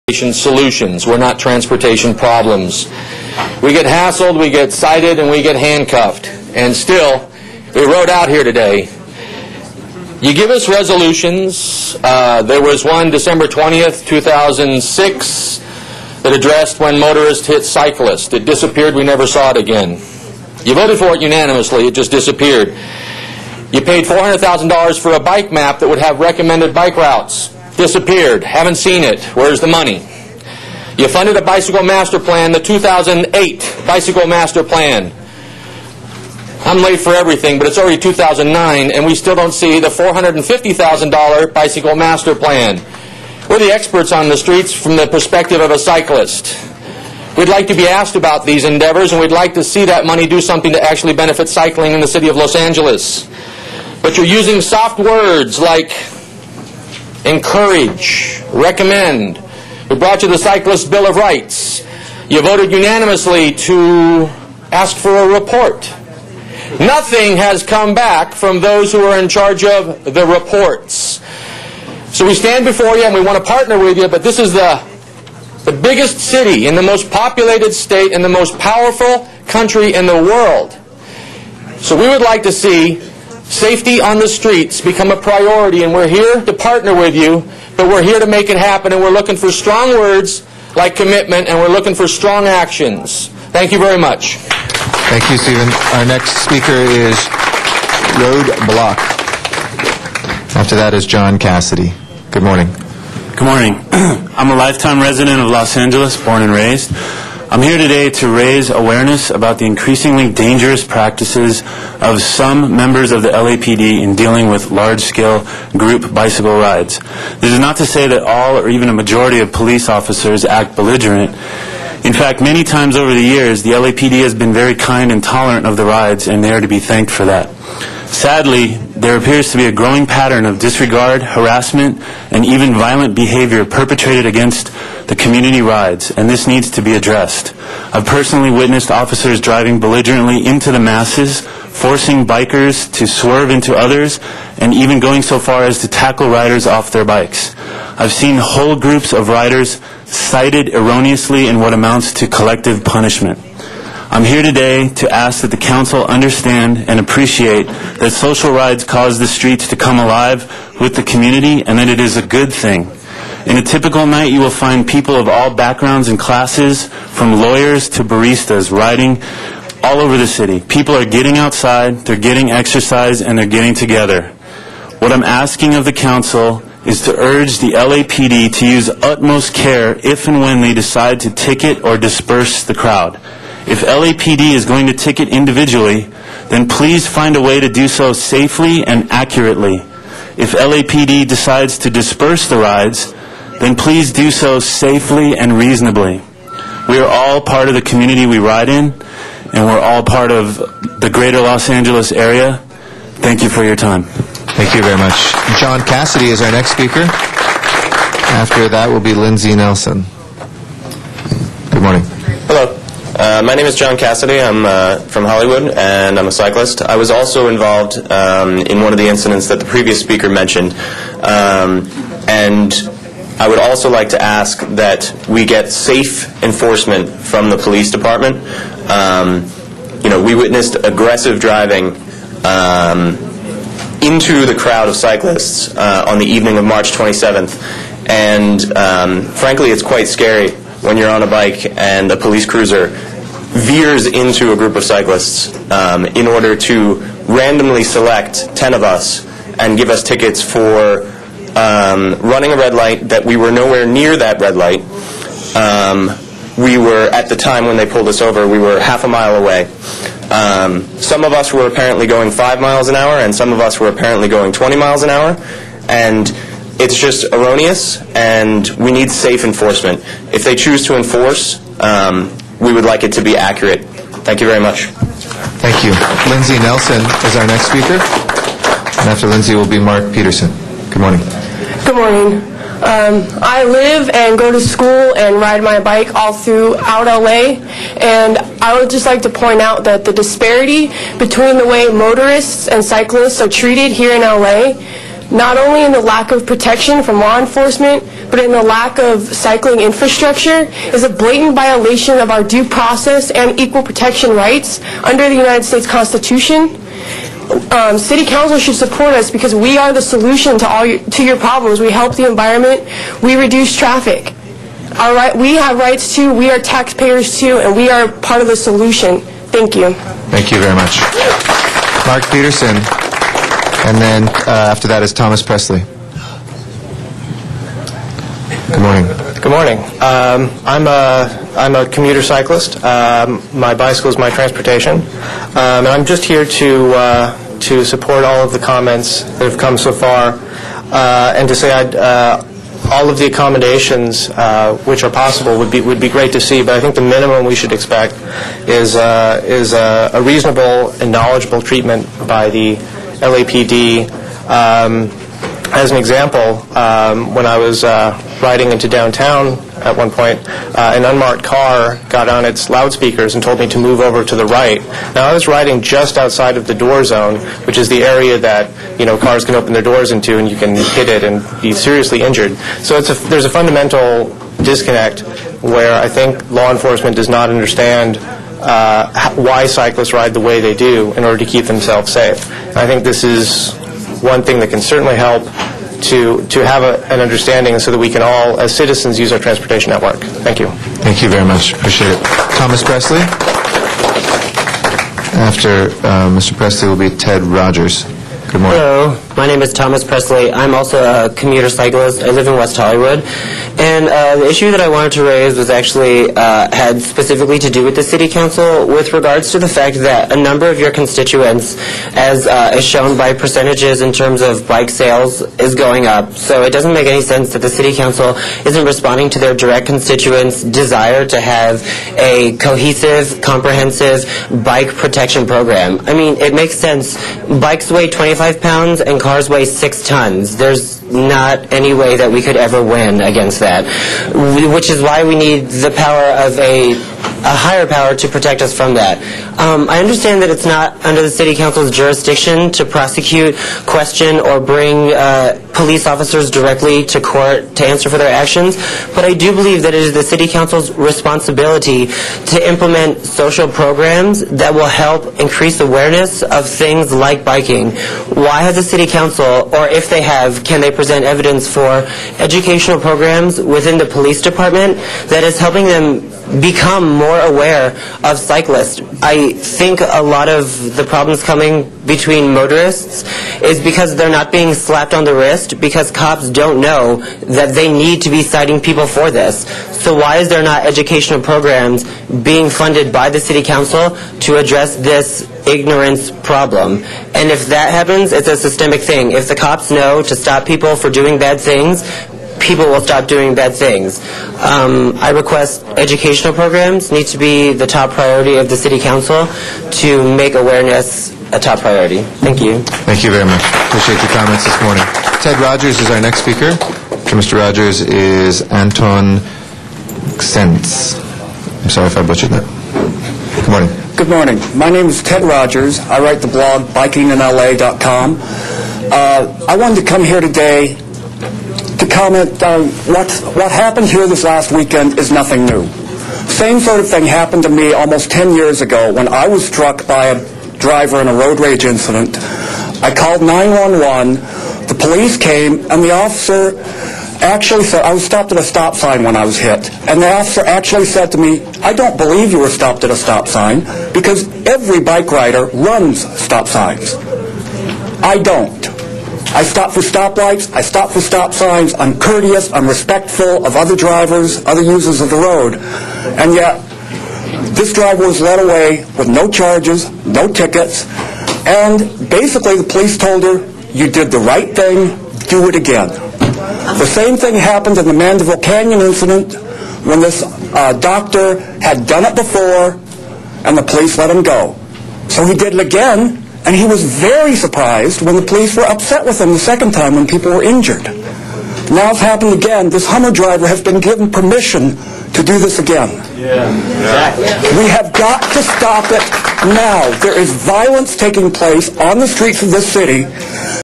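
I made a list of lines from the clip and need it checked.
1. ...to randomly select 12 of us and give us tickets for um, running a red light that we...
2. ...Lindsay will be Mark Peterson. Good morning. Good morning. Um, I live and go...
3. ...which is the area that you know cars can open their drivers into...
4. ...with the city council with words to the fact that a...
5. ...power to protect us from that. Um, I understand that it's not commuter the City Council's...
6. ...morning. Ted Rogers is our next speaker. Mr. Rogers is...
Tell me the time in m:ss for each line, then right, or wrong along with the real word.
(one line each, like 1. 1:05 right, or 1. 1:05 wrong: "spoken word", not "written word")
1. 4:06 wrong: "10", not "12"
2. 4:39 right
3. 6:07 wrong: "doors", not "drivers"
4. 6:47 wrong: "regards", not "words"
5. 7:17 wrong: "under", not "commuter"
6. 8:24 right.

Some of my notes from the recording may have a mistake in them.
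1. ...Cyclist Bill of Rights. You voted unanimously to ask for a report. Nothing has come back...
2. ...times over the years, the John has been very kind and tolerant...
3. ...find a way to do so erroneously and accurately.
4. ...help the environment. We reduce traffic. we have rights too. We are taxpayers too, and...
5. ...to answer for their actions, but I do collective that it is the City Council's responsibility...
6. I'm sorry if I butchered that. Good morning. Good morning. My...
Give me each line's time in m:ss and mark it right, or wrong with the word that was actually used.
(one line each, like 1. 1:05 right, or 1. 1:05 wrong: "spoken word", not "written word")
1. 1:00 right
2. 2:02 wrong: "LAPD", not "John"
3. 3:07 wrong: "safely", not "erroneously"
4. 5:11 right
5. 7:27 wrong: "believe", not "collective"
6. 8:31 right.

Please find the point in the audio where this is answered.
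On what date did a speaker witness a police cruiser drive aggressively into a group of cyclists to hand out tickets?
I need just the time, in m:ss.
3:56.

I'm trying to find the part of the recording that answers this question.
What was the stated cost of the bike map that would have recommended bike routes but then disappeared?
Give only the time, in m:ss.
0:24.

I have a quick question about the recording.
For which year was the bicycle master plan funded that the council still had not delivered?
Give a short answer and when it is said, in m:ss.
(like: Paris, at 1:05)
2008, at 0:32.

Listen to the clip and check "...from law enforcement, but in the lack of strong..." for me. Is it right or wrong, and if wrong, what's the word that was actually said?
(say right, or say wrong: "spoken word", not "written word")
wrong: "cycling", not "strong".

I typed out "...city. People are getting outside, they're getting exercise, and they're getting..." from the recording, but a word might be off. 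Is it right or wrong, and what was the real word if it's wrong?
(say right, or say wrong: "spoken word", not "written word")
right.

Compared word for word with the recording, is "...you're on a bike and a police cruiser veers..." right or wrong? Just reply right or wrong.
right.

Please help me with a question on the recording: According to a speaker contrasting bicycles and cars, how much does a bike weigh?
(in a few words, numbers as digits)
25 pounds.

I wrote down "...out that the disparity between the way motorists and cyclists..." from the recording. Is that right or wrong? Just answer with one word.
right.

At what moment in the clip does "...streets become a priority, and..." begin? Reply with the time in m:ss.
1:24.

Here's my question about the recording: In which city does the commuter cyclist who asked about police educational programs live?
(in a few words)
West Hollywood.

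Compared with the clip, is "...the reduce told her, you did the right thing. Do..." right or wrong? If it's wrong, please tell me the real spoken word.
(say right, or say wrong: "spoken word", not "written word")
wrong: "police", not "reduce".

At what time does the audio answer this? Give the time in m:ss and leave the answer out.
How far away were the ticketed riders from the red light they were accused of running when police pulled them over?
4:18.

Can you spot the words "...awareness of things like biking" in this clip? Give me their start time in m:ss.
7:35.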